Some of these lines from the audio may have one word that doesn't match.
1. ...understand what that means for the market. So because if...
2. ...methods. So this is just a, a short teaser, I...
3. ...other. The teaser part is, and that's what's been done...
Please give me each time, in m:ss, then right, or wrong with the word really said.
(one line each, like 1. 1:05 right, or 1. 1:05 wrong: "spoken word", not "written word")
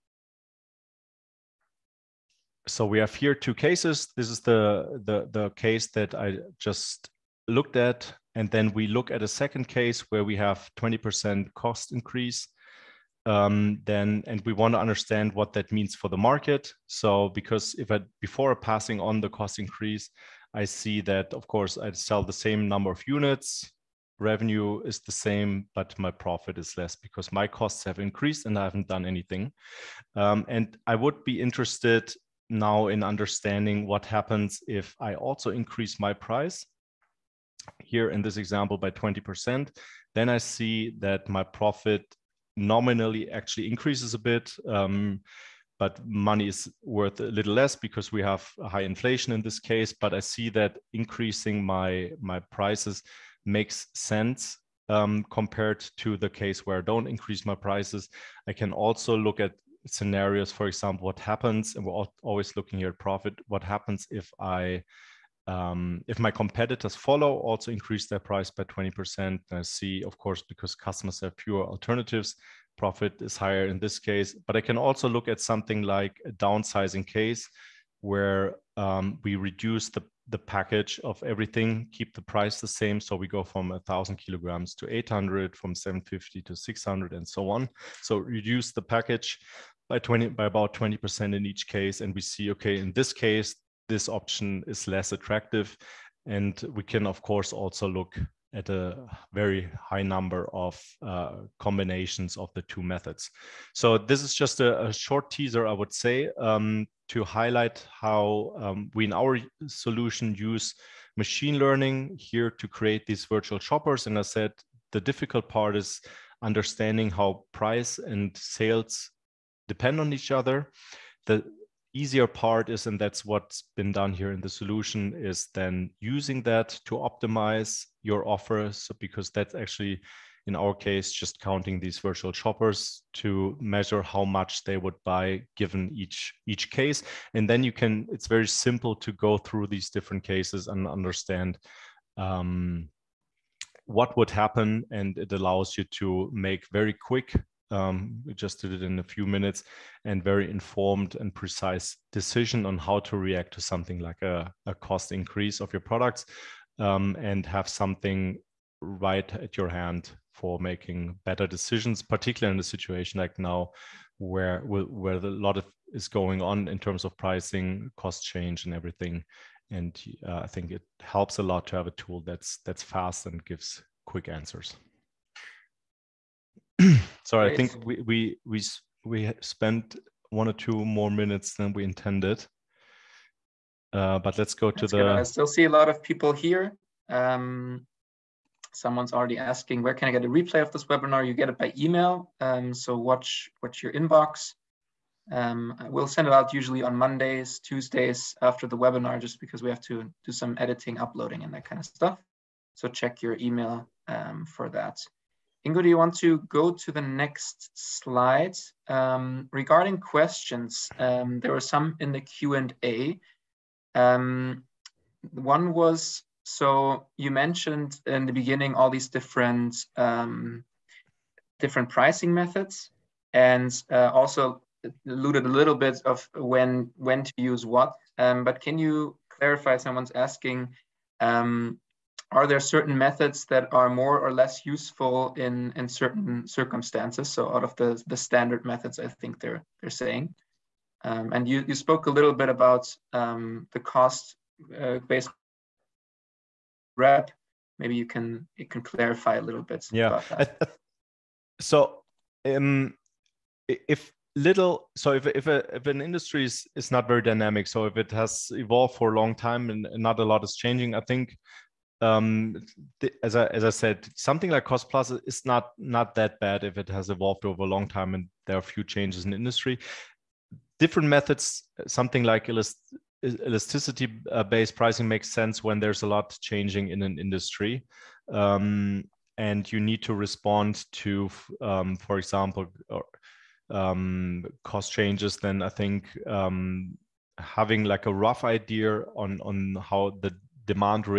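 1. 0:14 right
2. 1:42 right
3. 2:00 wrong: "easier", not "teaser".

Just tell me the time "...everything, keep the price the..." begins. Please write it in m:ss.
1:21.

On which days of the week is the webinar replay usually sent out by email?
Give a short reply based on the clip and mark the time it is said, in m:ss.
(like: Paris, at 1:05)
Mondays, Tuesdays, at 3:16.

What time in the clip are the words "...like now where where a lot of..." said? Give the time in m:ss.
2:43.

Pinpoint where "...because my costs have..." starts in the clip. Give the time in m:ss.
0:26.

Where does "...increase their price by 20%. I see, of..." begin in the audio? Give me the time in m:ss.
1:07.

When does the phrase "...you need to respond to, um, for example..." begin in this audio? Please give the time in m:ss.
4:39.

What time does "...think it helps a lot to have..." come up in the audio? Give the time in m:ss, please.
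2:50.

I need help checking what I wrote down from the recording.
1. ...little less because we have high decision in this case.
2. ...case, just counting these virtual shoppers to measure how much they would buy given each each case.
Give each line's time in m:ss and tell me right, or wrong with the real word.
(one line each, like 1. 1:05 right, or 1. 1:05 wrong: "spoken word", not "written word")
1. 0:47 wrong: "inflation", not "decision"
2. 2:10 right.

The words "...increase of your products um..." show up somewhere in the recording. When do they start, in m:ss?
2:35.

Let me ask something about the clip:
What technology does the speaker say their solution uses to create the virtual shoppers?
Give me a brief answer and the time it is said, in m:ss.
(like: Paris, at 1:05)
machine learning, at 1:51.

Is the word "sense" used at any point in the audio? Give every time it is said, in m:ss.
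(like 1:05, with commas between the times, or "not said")
0:53, 4:35.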